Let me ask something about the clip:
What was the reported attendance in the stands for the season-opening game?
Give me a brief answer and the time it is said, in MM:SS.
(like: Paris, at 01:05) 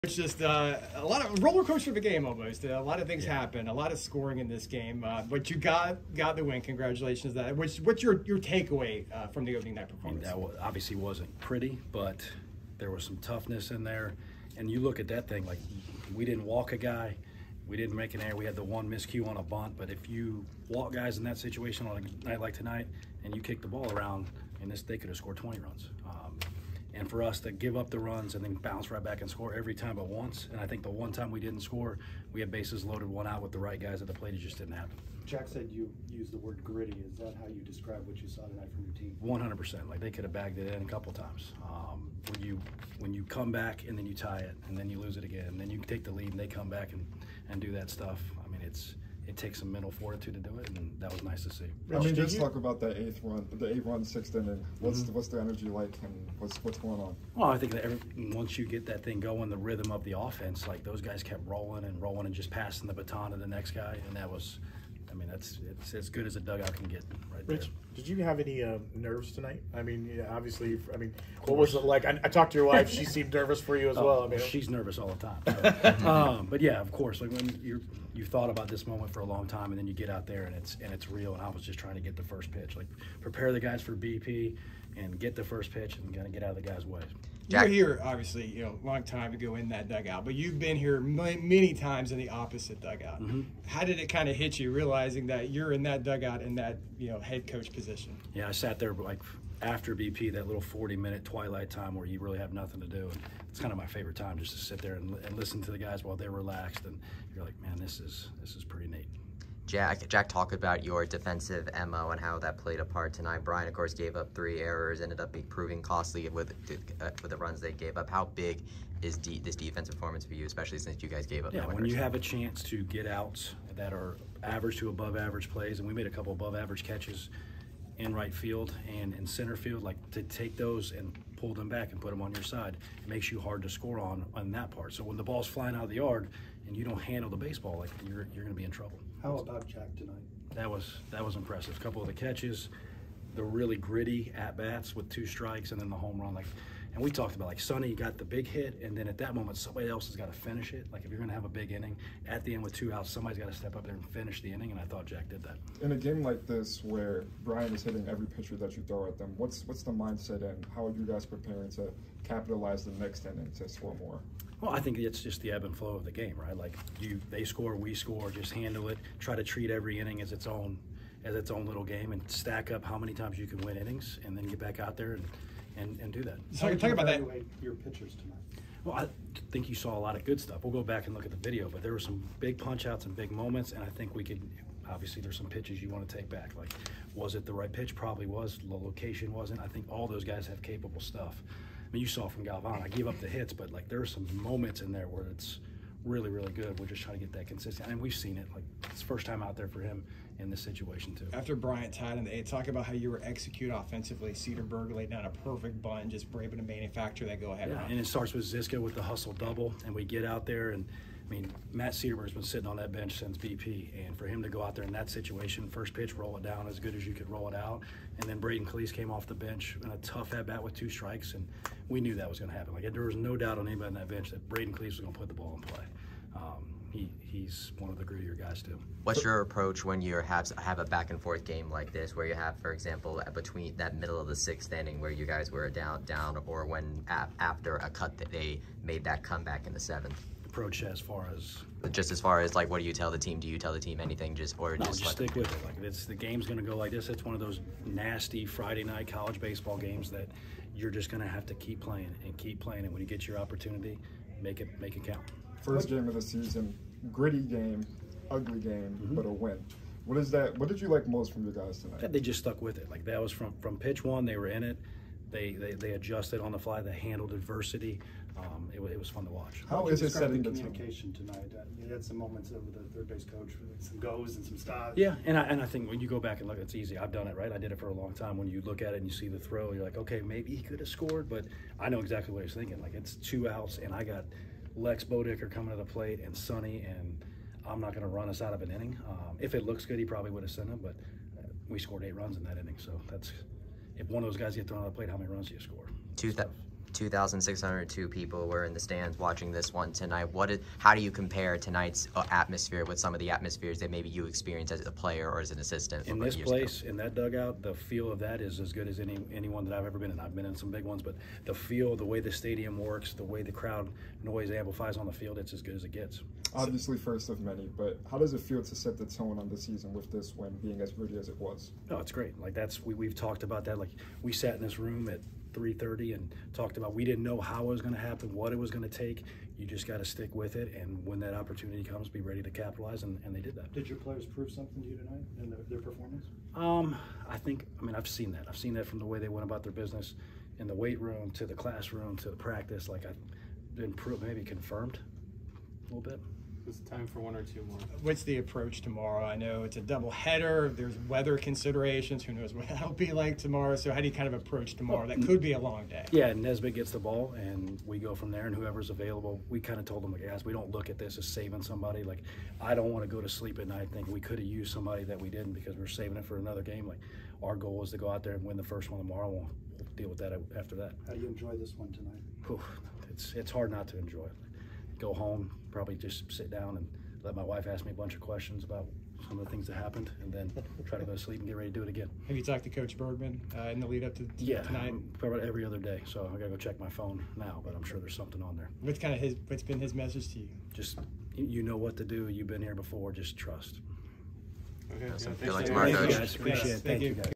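2,602, at 04:56.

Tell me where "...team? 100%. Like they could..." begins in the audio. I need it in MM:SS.
00:38.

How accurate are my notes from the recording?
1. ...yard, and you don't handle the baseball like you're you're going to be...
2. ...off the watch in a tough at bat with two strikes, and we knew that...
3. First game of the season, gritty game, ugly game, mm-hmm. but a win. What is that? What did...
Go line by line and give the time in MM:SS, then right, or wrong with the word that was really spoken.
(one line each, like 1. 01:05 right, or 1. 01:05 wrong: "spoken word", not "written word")
1. 02:15 right
2. 03:39 wrong: "bench", not "watch"
3. 04:15 right.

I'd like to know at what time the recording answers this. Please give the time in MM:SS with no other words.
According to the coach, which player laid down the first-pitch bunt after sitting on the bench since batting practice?
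03:31.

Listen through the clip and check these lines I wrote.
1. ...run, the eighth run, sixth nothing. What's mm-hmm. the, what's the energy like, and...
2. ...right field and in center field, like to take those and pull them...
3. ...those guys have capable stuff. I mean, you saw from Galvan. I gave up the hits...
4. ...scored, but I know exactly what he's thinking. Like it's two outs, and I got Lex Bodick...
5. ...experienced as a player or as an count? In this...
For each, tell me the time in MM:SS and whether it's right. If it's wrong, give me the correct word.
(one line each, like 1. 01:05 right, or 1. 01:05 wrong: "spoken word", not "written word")
1. 00:53 wrong: "inning", not "nothing"
2. 02:08 right
3. 03:10 right
4. 04:40 right
5. 05:04 wrong: "assistant", not "count".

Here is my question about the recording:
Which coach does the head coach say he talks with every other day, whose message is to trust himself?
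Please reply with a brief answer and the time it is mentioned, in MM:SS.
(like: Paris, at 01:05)
Coach Bergman, at 06:22.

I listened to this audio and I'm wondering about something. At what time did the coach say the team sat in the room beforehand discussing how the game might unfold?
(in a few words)
3:30.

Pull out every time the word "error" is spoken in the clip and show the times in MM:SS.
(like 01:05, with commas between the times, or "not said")
00:18, 01:54.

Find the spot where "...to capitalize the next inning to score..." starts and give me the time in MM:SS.
02:41.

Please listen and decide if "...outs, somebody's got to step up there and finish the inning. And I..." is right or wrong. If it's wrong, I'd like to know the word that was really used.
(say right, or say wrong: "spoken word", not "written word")
right.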